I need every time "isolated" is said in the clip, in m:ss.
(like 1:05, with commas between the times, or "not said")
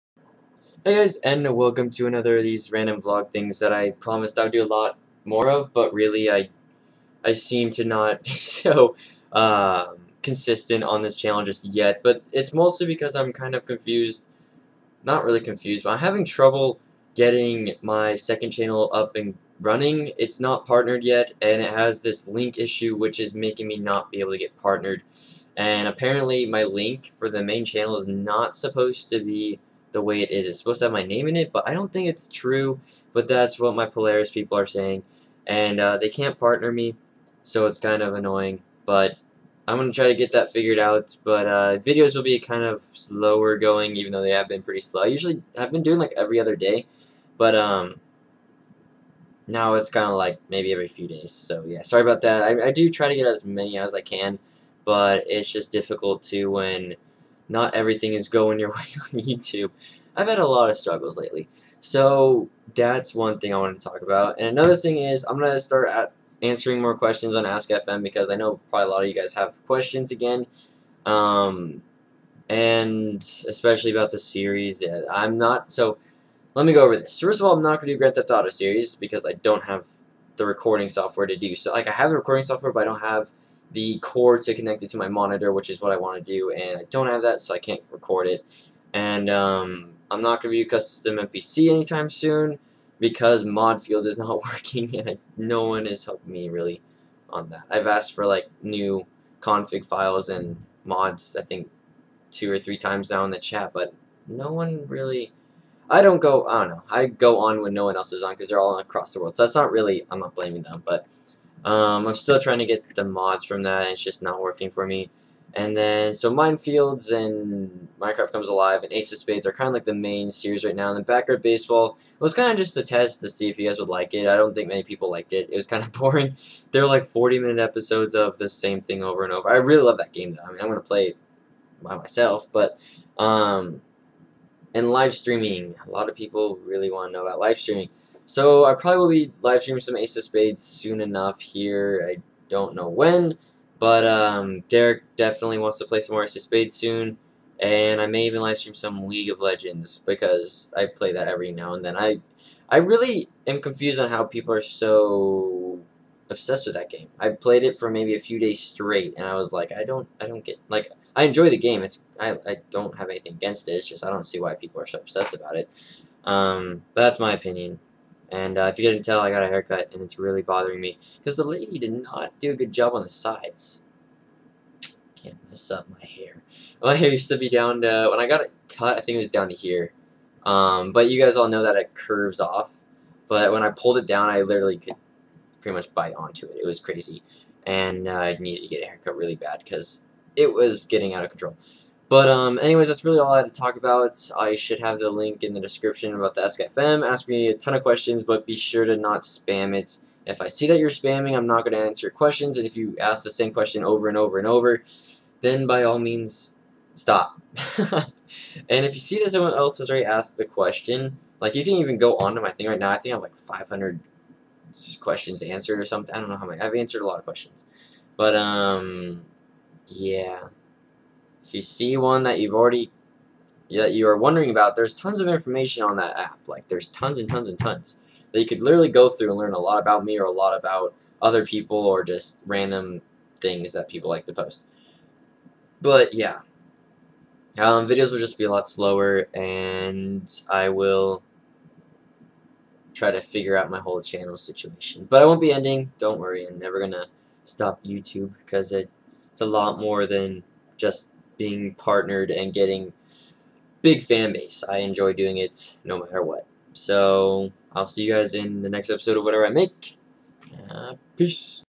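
not said.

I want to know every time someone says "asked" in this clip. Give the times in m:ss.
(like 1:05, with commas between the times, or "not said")
1:37, 3:30.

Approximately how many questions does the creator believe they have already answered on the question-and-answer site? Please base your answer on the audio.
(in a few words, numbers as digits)
500.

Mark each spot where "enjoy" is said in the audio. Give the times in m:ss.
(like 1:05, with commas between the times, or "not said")
2:41, 4:14.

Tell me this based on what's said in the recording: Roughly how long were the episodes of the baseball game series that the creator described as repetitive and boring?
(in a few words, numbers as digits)
40 minutes.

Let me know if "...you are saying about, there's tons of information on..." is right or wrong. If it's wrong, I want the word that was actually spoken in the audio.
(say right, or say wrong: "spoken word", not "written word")
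wrong: "wondering", not "saying".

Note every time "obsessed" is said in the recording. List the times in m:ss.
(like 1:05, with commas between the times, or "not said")
2:36, 2:44.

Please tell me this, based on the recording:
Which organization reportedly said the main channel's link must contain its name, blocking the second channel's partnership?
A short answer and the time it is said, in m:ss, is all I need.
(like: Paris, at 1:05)
Polaris, at 0:33.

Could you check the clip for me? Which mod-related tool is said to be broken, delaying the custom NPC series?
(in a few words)
Mod Field.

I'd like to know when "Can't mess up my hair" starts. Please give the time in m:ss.
2:55.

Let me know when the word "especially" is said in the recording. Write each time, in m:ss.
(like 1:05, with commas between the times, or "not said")
1:13.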